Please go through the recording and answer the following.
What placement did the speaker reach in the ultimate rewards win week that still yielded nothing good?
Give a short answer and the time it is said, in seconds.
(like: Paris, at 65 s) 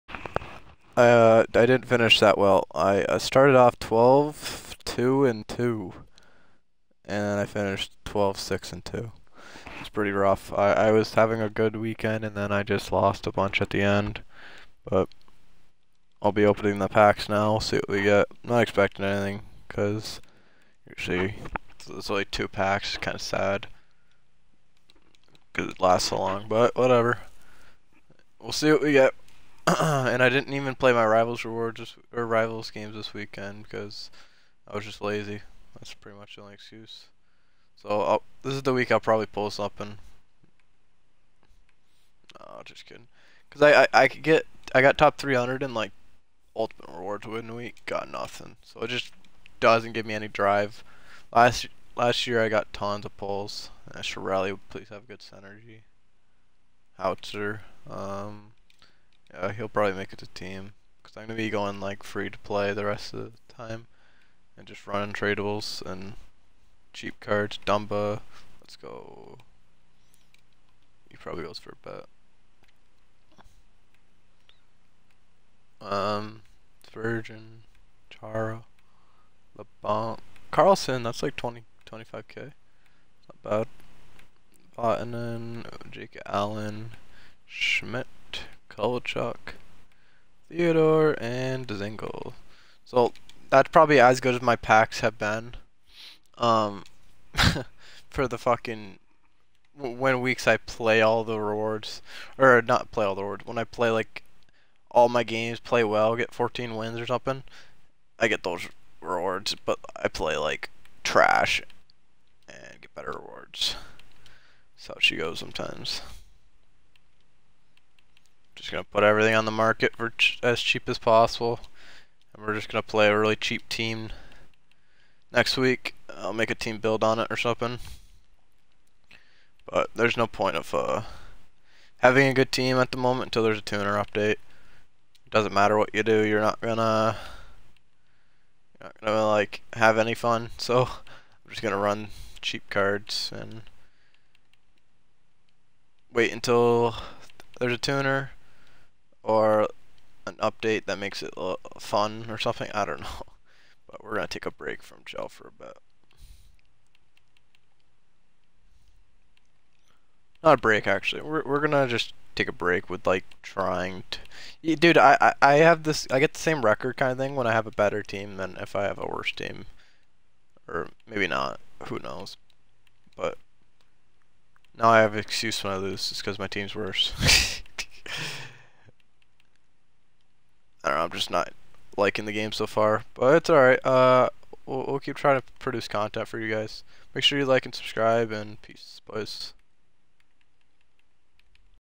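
top 300, at 44 s.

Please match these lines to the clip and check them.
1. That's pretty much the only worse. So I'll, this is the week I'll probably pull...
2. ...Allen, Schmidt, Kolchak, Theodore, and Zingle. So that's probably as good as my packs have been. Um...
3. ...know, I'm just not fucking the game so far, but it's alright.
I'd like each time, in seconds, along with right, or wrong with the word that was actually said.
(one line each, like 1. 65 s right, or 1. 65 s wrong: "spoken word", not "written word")
1. 35 s wrong: "excuse", not "worse"
2. 86 s right
3. 180 s wrong: "liking", not "fucking".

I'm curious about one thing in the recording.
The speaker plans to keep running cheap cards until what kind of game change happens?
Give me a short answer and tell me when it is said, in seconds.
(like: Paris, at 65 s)
a tuner update, at 133 s.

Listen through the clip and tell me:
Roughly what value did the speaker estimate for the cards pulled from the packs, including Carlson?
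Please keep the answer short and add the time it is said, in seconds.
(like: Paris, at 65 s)
20-25k, at 81 s.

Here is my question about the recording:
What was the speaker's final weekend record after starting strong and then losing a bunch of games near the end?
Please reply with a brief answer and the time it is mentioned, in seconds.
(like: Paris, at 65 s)
12-6-2, at 8 s.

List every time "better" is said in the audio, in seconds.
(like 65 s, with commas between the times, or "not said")
112 s, 167 s.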